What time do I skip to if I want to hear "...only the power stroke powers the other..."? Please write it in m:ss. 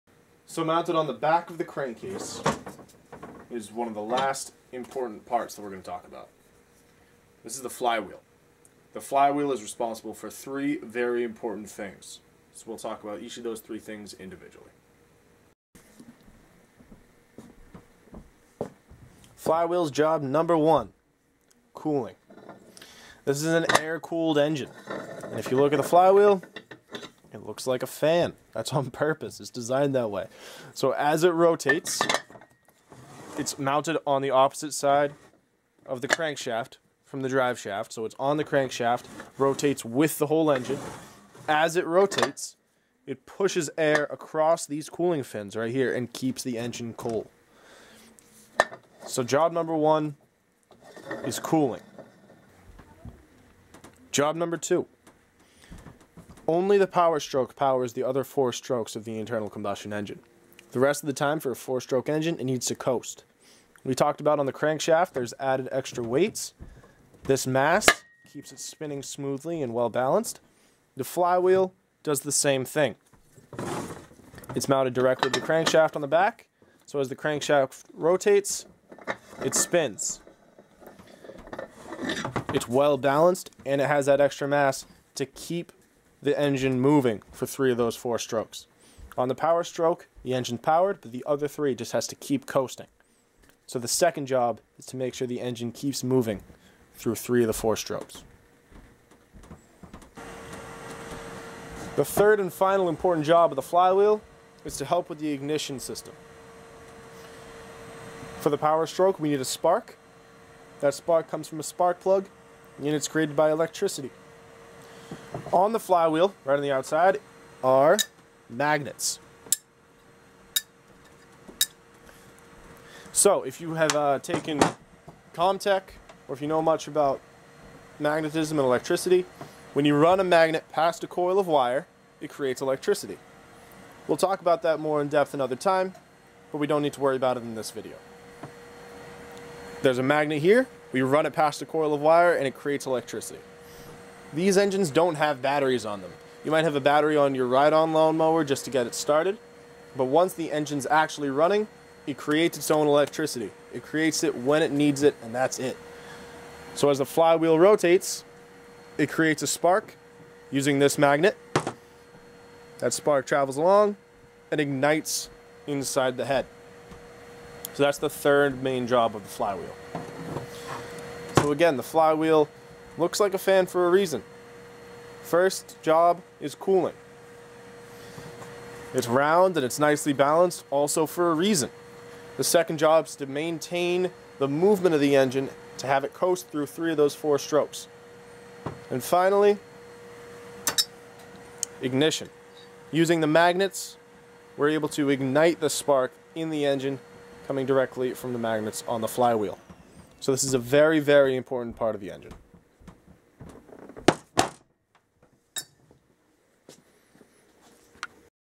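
0:56.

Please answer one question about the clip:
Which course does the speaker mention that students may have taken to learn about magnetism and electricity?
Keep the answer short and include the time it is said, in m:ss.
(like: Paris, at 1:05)
Comtech, at 2:05.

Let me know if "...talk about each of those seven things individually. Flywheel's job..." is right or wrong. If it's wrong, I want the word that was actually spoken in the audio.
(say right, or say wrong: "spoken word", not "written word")
wrong: "three", not "seven".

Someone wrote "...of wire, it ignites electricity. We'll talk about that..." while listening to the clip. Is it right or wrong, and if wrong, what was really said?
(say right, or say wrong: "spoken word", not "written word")
wrong: "creates", not "ignites".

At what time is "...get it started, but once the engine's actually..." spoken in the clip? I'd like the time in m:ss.
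2:28.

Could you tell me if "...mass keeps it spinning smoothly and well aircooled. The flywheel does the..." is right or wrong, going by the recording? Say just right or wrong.
wrong.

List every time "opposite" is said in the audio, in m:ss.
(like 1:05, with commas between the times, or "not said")
0:34.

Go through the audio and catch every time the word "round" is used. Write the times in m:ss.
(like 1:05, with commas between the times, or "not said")
2:59.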